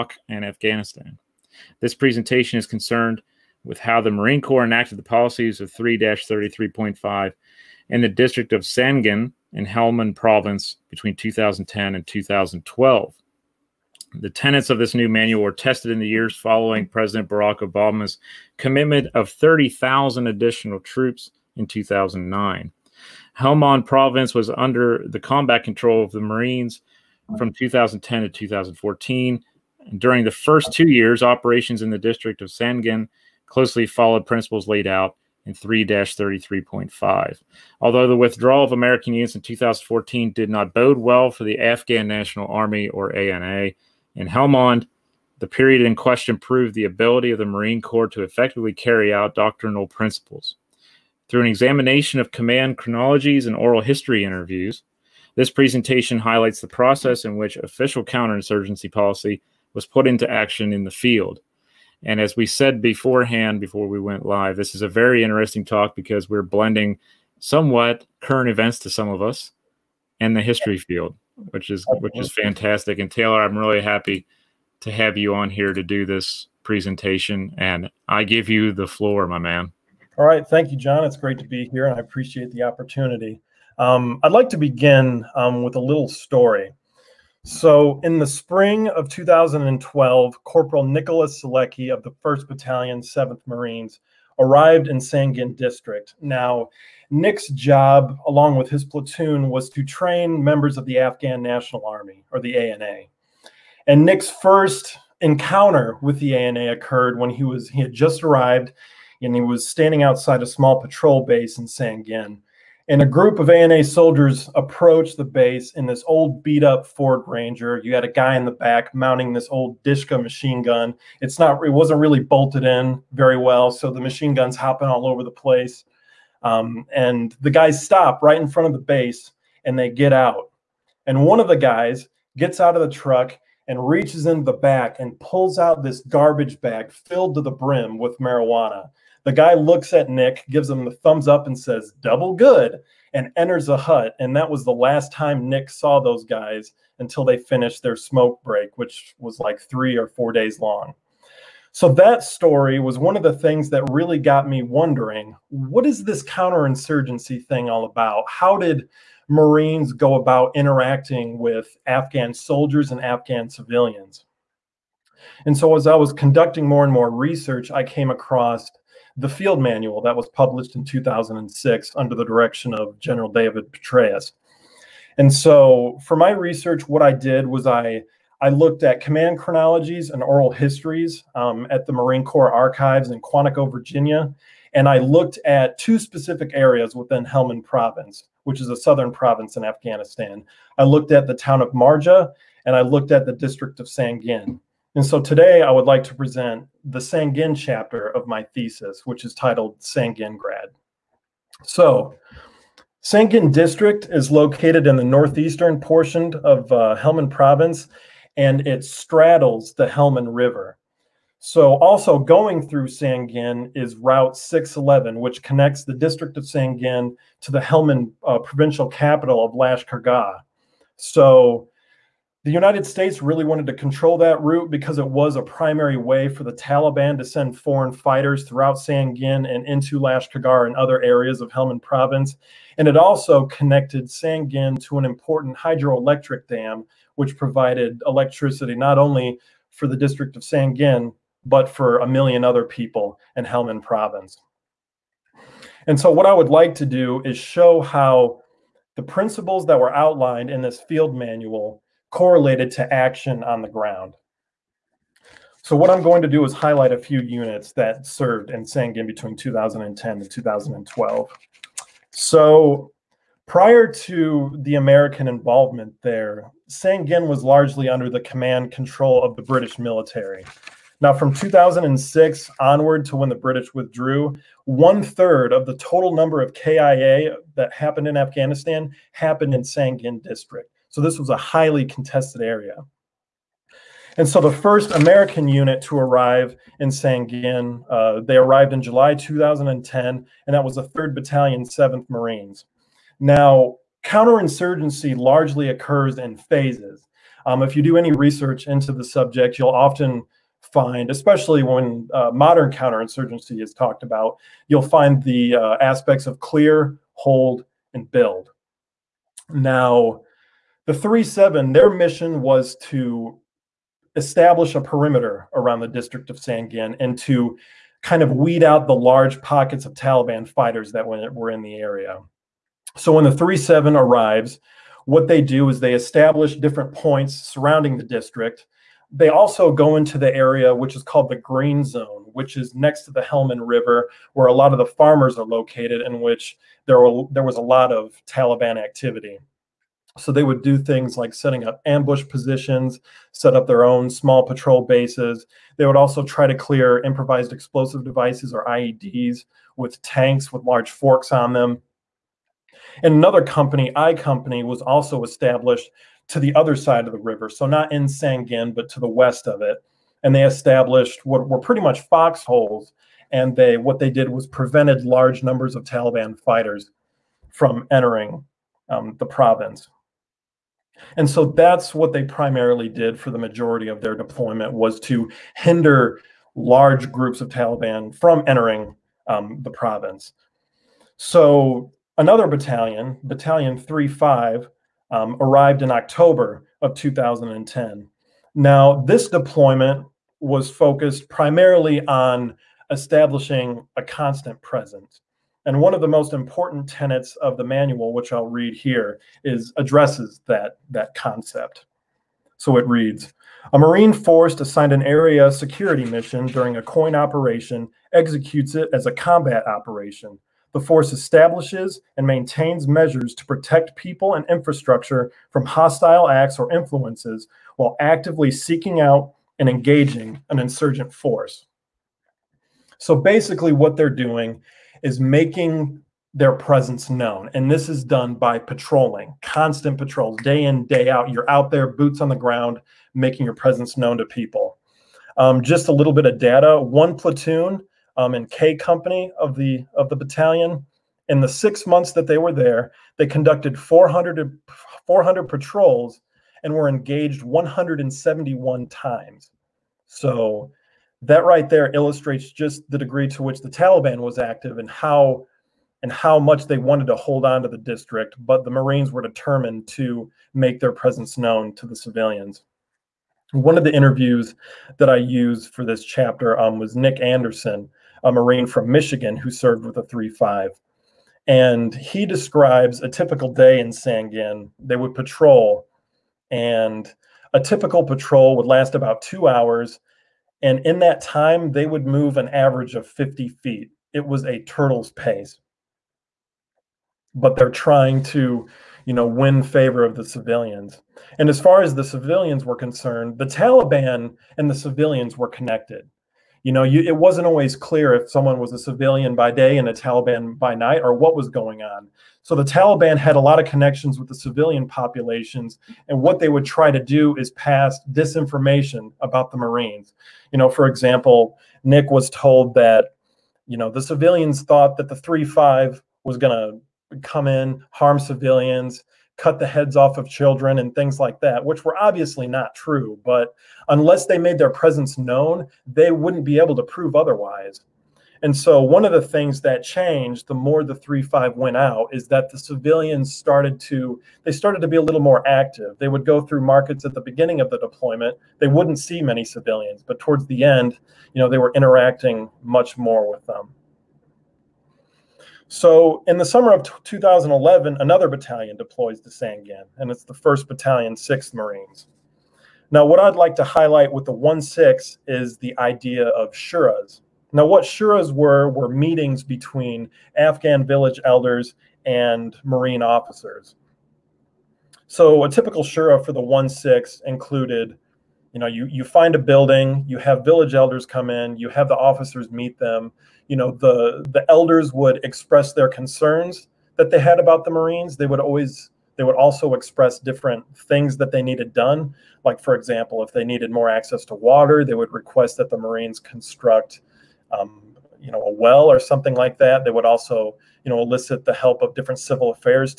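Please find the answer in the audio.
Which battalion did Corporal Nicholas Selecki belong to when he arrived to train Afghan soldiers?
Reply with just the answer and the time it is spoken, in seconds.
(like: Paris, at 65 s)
1st Battalion, 7th Marines, at 92 s.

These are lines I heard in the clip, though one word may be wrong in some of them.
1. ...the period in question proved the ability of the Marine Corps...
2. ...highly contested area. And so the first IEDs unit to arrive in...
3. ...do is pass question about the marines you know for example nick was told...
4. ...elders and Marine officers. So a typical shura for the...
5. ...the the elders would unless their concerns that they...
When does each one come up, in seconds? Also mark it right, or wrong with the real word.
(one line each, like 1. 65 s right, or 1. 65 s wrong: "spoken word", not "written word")
1. 45 s right
2. 281 s wrong: "American", not "IEDs"
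3. 507 s wrong: "disinformation", not "question"
4. 561 s right
5. 573 s wrong: "express", not "unless".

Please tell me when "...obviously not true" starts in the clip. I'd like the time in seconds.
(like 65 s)
521 s.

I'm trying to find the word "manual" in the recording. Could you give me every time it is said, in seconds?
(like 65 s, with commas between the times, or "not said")
15 s, 169 s, 251 s, 397 s.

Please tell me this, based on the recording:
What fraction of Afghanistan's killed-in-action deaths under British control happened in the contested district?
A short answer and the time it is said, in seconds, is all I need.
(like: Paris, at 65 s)
One third, at 274 s.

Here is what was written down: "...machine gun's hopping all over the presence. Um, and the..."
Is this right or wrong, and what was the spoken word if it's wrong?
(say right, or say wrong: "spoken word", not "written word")
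wrong: "place", not "presence".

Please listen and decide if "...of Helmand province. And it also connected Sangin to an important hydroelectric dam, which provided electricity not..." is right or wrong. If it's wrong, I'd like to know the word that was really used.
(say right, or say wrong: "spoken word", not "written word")
right.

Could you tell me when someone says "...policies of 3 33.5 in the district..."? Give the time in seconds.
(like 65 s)
5 s.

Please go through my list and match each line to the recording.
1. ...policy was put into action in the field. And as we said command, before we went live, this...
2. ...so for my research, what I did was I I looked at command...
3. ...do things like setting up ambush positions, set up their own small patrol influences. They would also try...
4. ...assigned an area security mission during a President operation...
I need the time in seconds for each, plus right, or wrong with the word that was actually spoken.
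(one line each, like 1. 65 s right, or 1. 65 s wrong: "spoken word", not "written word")
1. 58 s wrong: "beforehand", not "command"
2. 175 s right
3. 340 s wrong: "bases", not "influences"
4. 404 s wrong: "COIN", not "President".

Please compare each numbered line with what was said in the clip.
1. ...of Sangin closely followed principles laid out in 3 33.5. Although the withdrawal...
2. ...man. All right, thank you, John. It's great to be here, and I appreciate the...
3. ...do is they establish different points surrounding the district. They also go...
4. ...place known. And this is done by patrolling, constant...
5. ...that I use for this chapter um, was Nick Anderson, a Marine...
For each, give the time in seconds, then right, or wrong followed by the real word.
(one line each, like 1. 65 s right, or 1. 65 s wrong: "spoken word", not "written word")
1. 32 s right
2. 79 s right
3. 325 s right
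4. 426 s wrong: "presence", not "place"
5. 464 s right.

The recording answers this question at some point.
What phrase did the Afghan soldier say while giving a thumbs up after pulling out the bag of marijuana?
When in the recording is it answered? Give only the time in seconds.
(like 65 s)
142 s.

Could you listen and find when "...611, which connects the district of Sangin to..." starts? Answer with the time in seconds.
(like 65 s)
214 s.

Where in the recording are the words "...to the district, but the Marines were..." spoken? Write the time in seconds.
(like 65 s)
457 s.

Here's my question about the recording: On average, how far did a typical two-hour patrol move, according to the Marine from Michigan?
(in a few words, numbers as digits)
50 feet.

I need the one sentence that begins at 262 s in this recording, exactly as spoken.
So prior to the American involvement there, Sangin was largely under the command control of the British military.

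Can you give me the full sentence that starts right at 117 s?
You had a guy in the back mounting this old Dishka machine gun.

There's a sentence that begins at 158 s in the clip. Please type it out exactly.
How did Marines go about interacting with Afghan soldiers and Afghan civilians?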